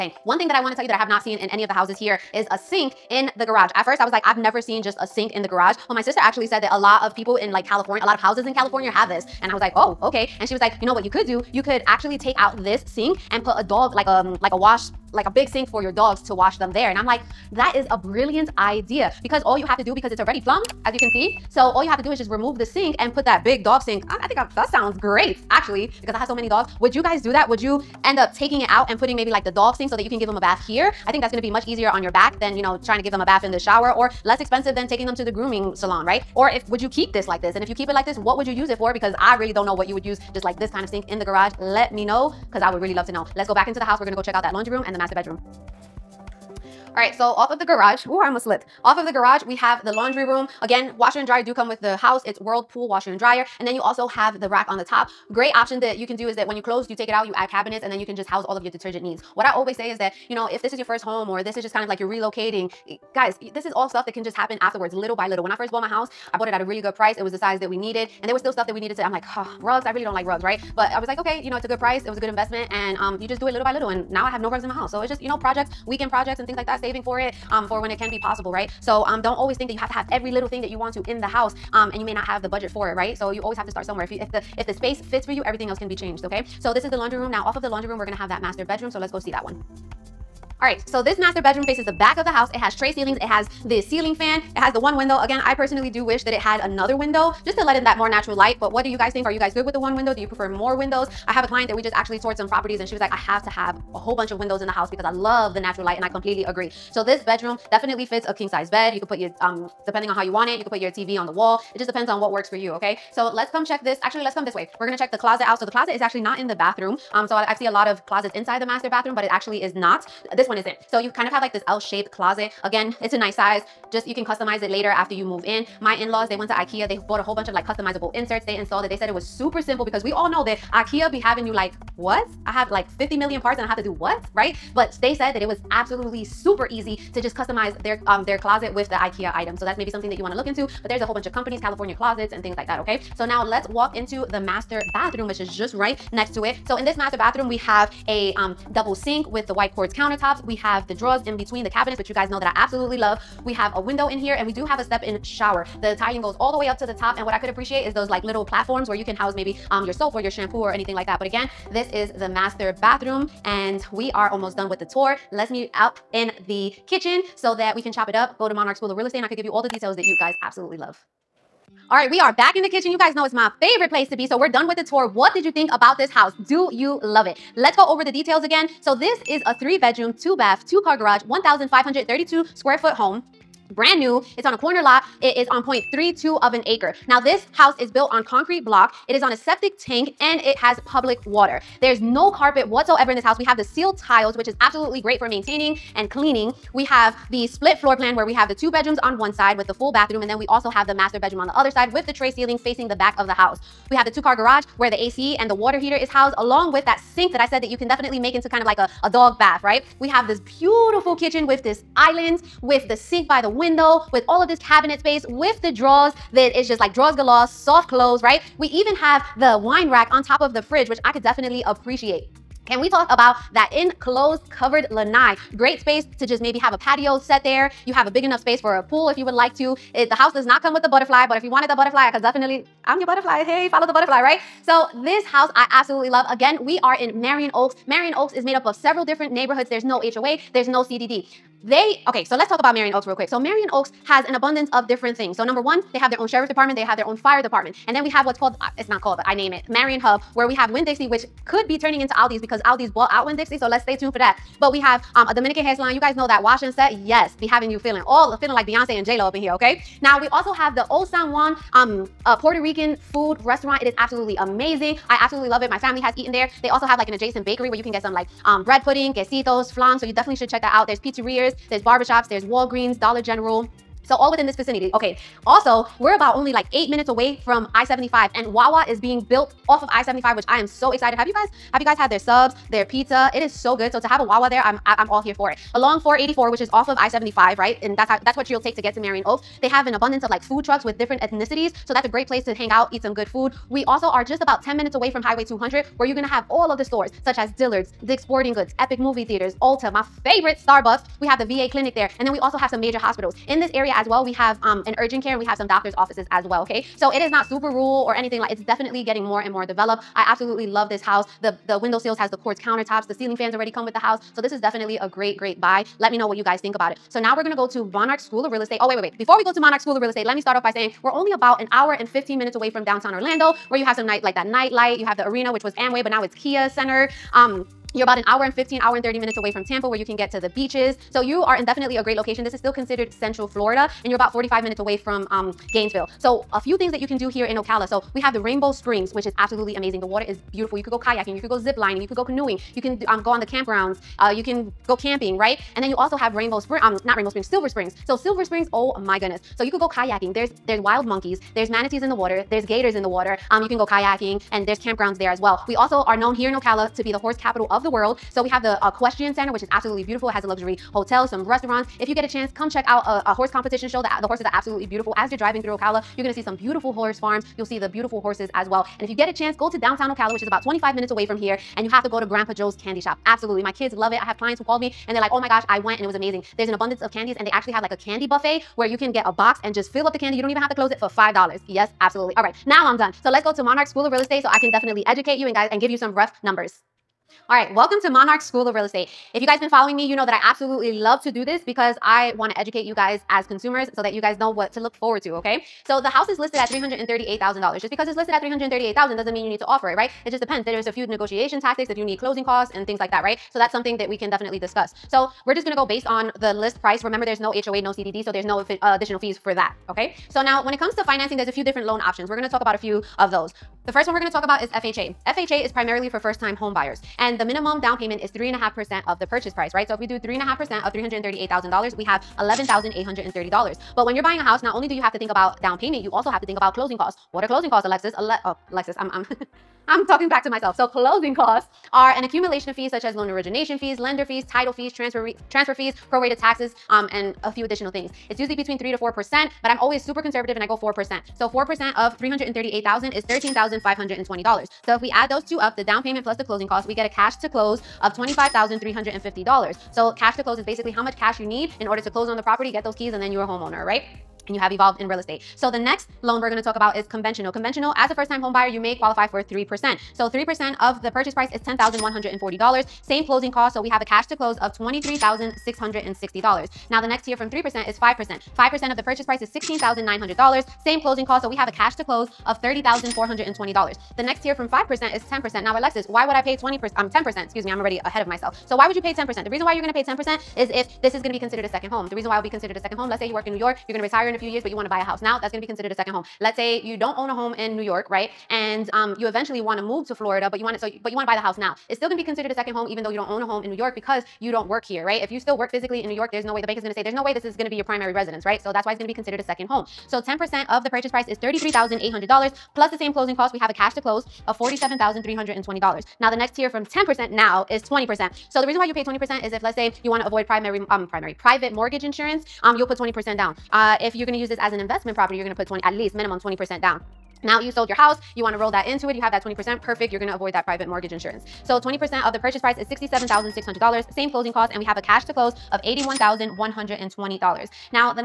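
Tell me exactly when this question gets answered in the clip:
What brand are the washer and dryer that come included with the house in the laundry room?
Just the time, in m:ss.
0:52.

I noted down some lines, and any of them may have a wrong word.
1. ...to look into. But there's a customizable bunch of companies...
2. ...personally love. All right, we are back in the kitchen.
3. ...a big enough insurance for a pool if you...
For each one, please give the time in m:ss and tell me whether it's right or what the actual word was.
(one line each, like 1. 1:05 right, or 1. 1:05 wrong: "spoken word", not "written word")
1. 2:20 wrong: "whole", not "customizable"
2. 2:50 wrong: "absolutely", not "personally"
3. 3:48 wrong: "space", not "insurance".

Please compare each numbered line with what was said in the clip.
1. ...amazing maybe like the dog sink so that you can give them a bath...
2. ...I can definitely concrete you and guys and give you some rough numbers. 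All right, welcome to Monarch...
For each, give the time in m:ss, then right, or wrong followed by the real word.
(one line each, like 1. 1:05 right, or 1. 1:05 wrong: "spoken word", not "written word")
1. 0:28 wrong: "putting", not "amazing"
2. 6:24 wrong: "educate", not "concrete".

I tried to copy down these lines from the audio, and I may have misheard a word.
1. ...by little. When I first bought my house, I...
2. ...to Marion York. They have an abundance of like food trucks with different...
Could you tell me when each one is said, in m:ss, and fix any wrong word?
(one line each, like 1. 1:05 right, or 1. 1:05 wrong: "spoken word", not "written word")
1. 1:05 right
2. 4:48 wrong: "Oaks", not "York".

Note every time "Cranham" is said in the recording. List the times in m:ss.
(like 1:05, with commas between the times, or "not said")
not said.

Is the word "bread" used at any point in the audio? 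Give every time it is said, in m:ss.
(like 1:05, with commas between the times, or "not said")
4:28.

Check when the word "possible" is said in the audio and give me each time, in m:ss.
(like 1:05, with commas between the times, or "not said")
1:18.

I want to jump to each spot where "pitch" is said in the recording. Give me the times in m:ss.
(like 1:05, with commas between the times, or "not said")
not said.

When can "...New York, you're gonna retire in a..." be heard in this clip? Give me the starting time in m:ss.
8:03.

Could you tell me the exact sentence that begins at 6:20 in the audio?
You don't even have to close it for $5.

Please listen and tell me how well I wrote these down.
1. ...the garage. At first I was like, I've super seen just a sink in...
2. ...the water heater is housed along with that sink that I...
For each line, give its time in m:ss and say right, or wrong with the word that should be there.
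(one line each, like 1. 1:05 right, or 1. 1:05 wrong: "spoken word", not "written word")
1. 0:03 wrong: "never", not "super"
2. 3:25 right.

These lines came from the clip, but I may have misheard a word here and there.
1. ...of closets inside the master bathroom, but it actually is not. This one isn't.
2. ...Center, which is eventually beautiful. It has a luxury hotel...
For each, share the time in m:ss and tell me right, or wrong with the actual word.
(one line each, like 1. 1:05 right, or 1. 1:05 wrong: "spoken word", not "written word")
1. 1:57 right
2. 5:59 wrong: "absolutely", not "eventually".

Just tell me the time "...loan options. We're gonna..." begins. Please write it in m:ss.
6:51.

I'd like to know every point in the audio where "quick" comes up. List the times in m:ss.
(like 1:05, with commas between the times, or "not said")
4:03.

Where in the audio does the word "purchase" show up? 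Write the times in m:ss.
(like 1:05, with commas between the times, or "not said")
6:59, 8:20, 8:42.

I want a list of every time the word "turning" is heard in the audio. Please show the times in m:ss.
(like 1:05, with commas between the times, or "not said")
4:11.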